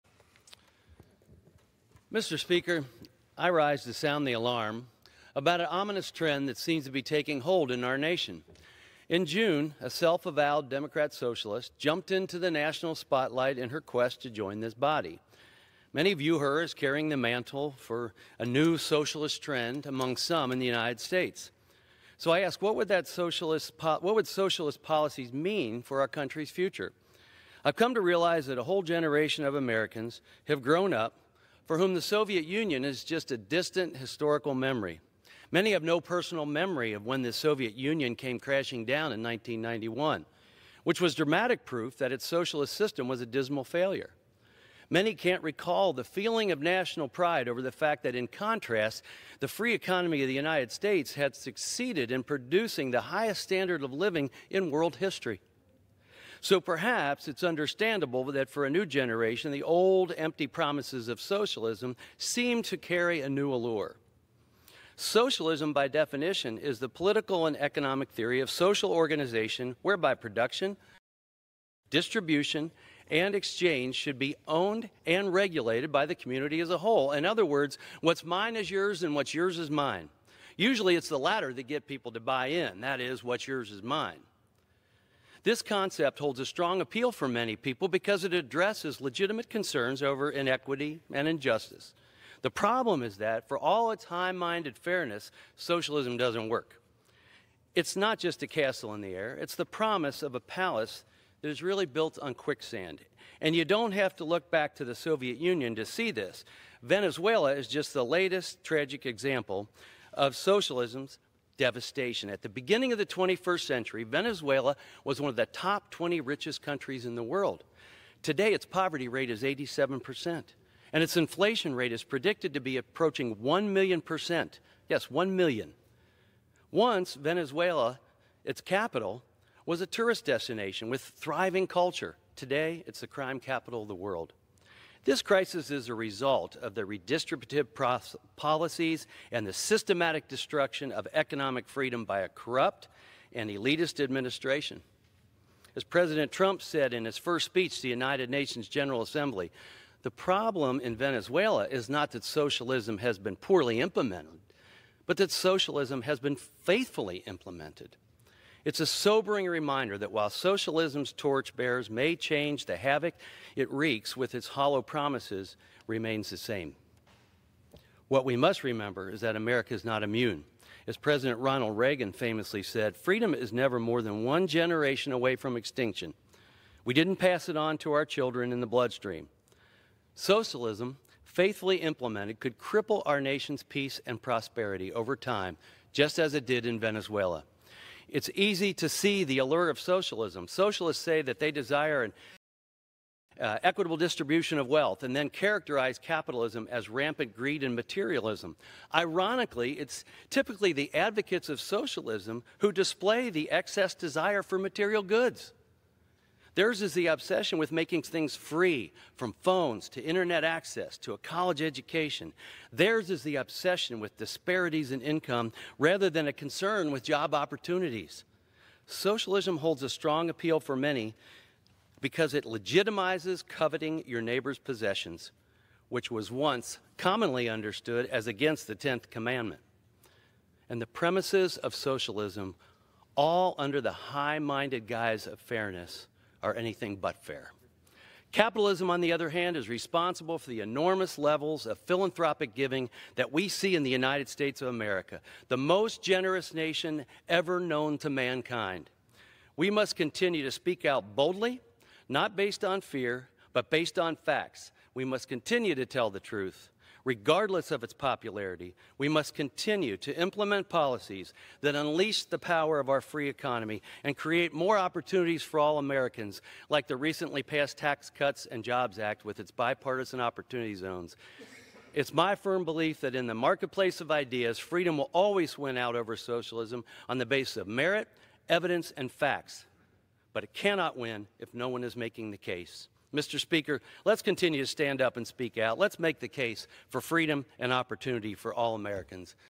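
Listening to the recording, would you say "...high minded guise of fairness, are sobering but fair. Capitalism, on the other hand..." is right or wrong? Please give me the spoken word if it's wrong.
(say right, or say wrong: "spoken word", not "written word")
wrong: "anything", not "sobering".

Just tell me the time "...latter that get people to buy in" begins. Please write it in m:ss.
1:21.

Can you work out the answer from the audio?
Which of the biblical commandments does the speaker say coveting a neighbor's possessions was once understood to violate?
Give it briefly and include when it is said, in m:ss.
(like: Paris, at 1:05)
10th, at 3:48.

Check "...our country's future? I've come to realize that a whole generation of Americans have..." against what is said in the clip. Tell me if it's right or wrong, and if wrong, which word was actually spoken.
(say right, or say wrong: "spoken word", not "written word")
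right.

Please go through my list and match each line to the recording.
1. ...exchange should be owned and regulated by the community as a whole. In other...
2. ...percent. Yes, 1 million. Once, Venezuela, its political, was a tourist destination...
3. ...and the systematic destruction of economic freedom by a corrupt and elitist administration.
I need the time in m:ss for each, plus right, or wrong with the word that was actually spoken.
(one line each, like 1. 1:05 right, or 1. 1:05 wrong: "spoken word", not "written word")
1. 1:13 right
2. 2:04 wrong: "capital", not "political"
3. 2:19 right.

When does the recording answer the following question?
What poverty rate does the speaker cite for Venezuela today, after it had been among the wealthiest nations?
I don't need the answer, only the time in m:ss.
1:59.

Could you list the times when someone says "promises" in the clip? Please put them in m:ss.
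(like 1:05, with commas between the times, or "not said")
1:00, 1:39, 2:44.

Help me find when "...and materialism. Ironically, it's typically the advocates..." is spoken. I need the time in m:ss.
3:17.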